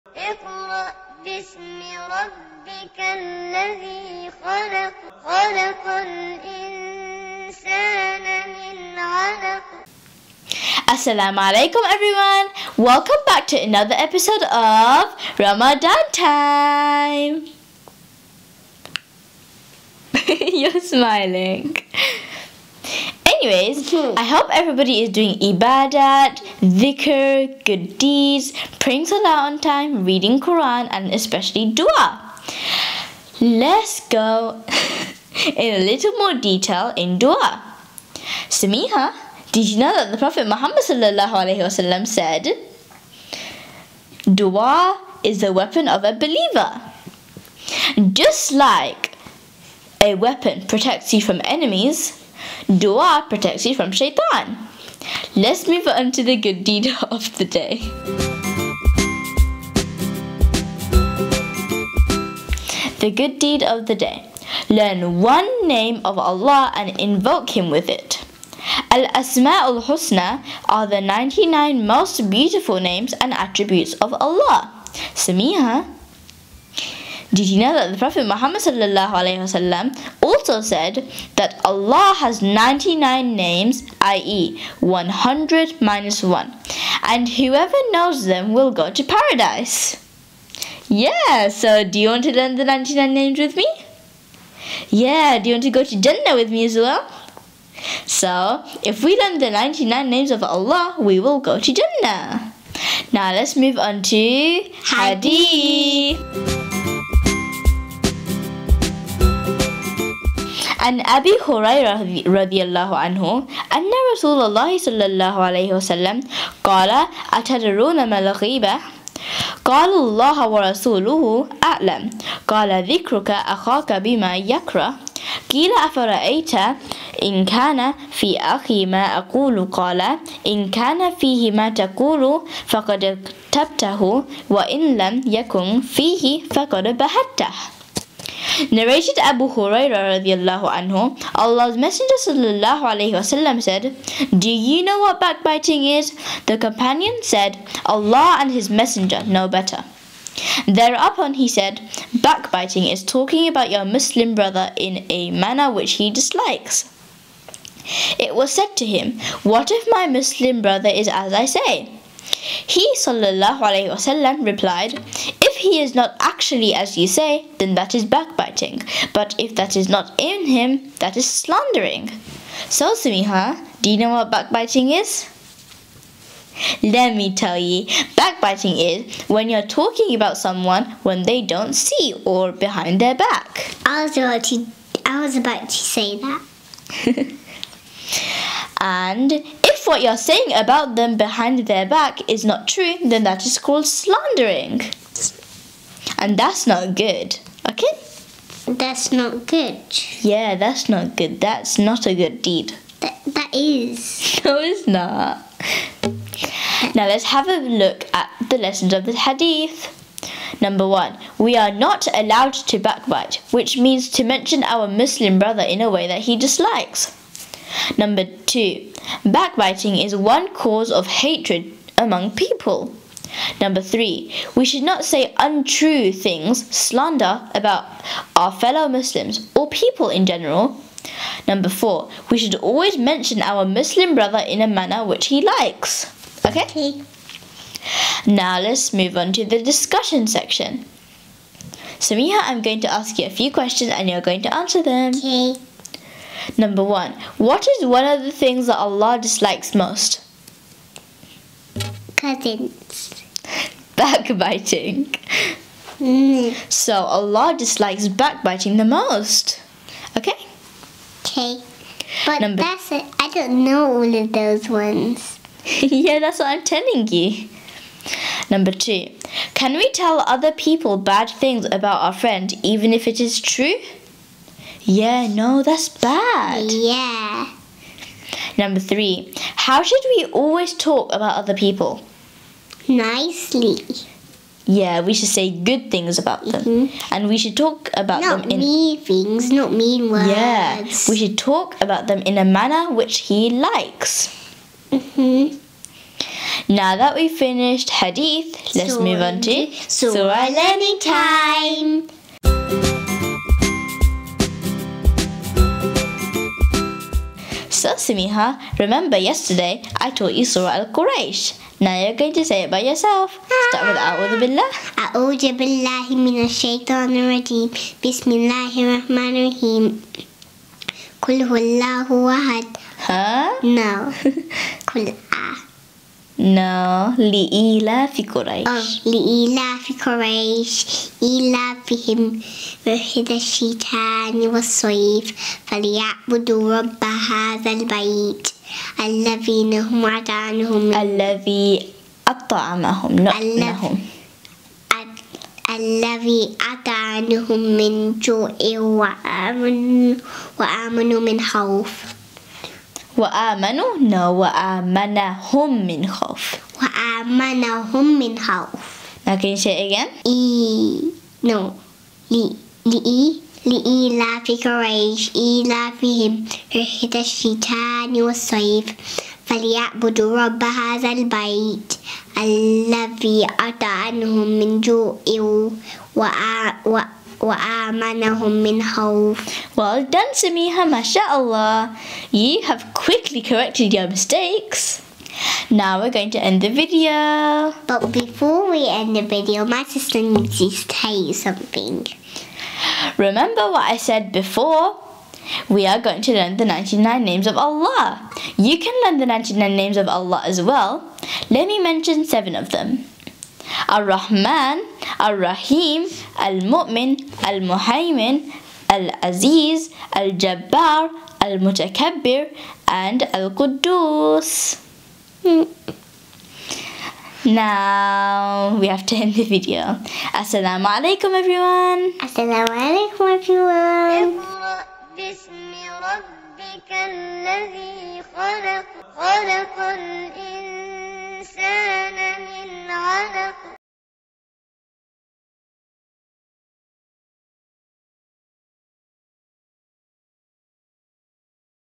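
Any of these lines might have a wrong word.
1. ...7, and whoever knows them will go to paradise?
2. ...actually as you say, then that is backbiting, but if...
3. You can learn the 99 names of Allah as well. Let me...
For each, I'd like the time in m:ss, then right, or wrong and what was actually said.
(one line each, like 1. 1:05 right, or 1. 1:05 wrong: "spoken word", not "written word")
1. 1:26 wrong: "1", not "7"
2. 2:46 right
3. 6:38 right.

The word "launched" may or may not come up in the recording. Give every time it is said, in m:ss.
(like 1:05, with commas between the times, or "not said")
not said.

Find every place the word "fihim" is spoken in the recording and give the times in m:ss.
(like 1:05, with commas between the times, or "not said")
5:31.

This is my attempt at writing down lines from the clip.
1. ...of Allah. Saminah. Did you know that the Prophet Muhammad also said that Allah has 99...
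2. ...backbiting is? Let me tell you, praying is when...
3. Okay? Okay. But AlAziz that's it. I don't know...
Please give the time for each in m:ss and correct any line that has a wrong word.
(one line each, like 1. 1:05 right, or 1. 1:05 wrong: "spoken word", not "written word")
1. 1:13 right
2. 2:54 wrong: "backbiting", not "praying"
3. 4:20 wrong: "Number", not "AlAziz".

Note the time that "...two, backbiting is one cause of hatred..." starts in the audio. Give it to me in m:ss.
3:38.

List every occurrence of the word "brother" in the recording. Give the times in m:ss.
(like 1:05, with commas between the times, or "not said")
2:34, 2:40, 3:35, 3:54.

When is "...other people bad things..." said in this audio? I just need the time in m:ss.
4:30.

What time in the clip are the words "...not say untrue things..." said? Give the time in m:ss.
3:44.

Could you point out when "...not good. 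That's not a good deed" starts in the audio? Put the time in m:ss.
3:20.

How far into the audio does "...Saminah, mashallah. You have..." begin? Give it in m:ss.
6:20.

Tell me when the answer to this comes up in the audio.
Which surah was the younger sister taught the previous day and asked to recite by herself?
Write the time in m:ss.
5:10.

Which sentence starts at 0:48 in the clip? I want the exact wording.
Just like a weapon protects you from enemies, dua protects you from shaitan.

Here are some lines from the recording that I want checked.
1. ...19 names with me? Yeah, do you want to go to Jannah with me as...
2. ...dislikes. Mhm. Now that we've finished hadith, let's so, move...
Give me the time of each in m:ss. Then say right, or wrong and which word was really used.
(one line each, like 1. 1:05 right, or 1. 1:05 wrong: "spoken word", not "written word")
1. 1:32 wrong: "99", not "19"
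2. 4:53 wrong: "likes", not "dislikes".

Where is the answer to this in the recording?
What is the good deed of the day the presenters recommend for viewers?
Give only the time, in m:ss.
1:04.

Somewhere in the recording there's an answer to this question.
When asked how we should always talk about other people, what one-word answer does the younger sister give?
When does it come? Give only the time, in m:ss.
4:42.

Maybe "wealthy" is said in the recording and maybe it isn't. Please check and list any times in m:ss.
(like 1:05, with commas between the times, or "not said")
not said.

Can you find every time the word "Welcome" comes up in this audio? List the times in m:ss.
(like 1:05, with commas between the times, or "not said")
0:12.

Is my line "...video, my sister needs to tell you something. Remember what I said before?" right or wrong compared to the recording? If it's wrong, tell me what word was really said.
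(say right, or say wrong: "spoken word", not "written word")
right.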